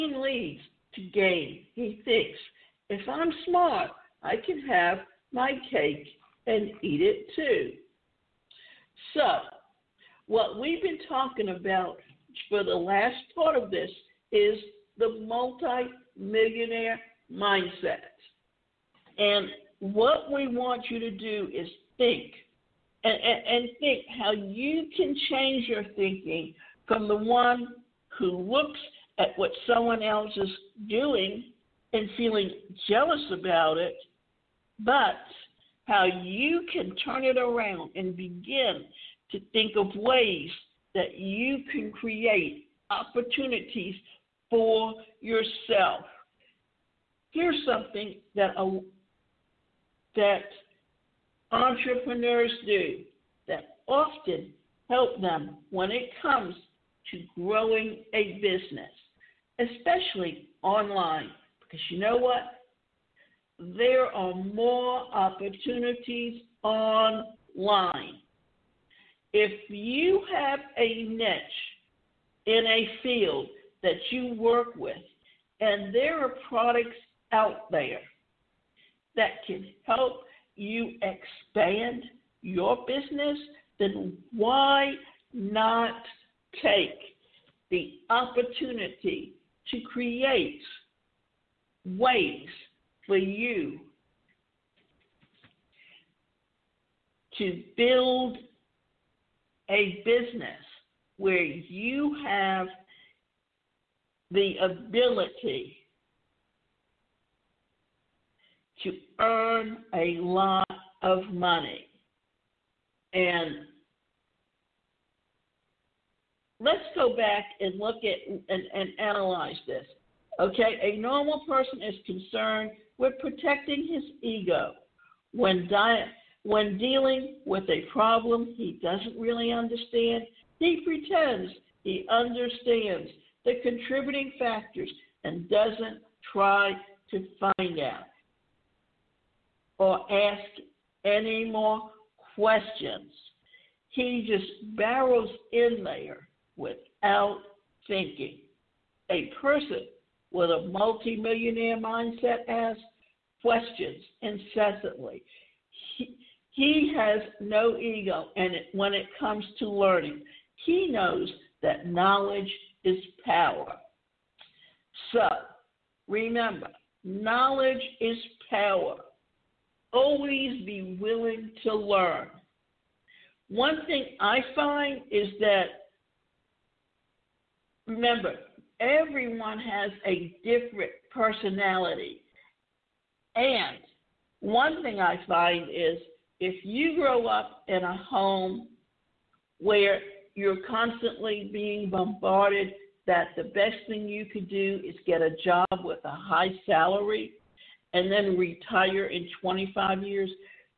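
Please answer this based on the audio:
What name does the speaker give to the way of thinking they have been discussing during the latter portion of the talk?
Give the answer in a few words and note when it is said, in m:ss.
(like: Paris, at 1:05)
multi millionaire mindset, at 0:15.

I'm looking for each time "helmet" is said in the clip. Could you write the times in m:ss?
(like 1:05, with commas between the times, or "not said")
not said.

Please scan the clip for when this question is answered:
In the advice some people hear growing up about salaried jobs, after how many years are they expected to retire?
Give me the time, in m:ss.
3:19.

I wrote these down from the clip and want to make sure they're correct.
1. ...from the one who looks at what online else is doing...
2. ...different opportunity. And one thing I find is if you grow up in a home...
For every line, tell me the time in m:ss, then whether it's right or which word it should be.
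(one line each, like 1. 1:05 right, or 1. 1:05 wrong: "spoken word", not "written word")
1. 0:26 wrong: "someone", not "online"
2. 3:00 wrong: "personality", not "opportunity".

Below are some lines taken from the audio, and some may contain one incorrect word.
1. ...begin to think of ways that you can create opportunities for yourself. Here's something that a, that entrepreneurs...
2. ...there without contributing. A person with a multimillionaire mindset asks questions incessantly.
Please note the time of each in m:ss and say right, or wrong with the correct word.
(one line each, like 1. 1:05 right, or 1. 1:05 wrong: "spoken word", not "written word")
1. 0:38 right
2. 2:25 wrong: "thinking", not "contributing".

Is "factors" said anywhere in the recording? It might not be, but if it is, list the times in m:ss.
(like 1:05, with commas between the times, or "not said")
2:14.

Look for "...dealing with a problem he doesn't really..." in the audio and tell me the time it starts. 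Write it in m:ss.
2:06.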